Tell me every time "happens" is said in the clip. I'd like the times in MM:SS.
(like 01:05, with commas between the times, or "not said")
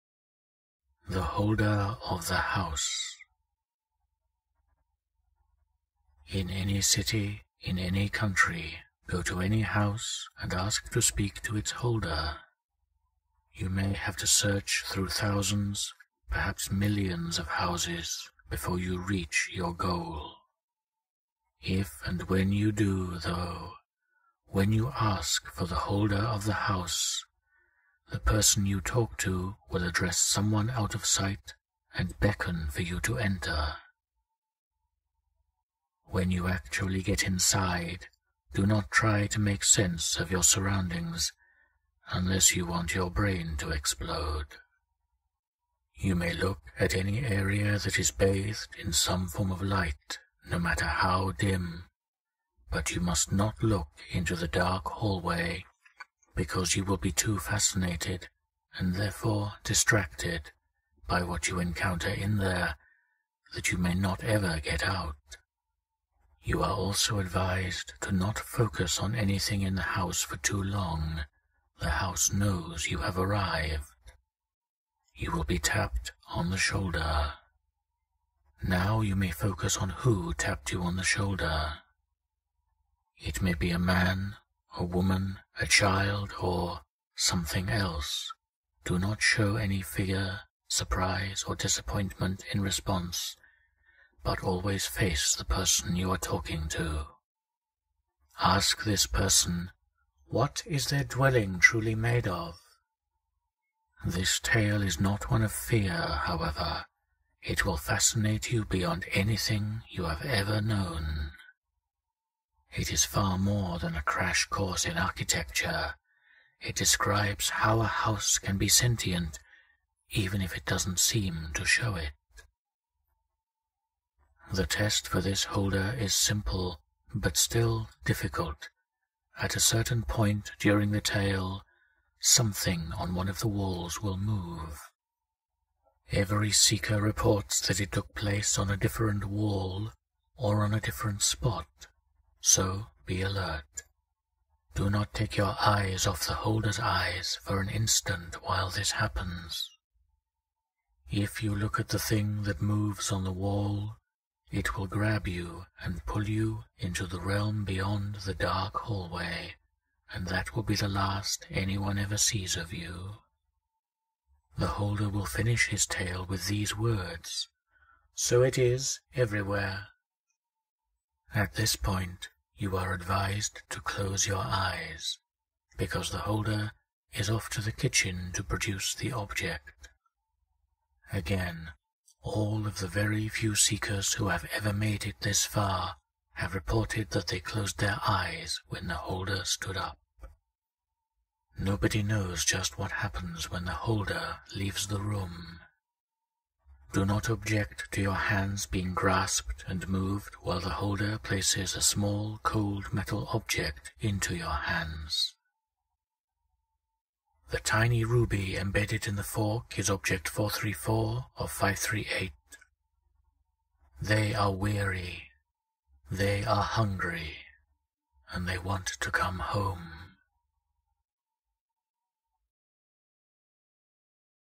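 02:28, 03:12.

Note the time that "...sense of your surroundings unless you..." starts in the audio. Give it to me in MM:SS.
00:39.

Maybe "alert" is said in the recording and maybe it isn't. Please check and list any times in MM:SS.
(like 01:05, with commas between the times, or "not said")
02:23.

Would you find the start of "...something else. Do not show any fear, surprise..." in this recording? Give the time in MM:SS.
01:27.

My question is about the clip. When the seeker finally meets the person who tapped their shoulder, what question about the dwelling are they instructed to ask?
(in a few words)
What is their dwelling truly made of.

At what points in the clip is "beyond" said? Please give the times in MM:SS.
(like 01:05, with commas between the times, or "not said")
01:48, 02:37.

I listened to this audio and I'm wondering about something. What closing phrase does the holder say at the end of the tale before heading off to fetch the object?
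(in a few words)
So it is everywhere.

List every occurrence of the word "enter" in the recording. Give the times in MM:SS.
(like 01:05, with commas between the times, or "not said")
00:33.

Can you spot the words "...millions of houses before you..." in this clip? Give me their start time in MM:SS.
00:16.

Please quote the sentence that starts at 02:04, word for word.
The test for this holder is simple, but still difficult.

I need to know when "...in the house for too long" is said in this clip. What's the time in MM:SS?
01:09.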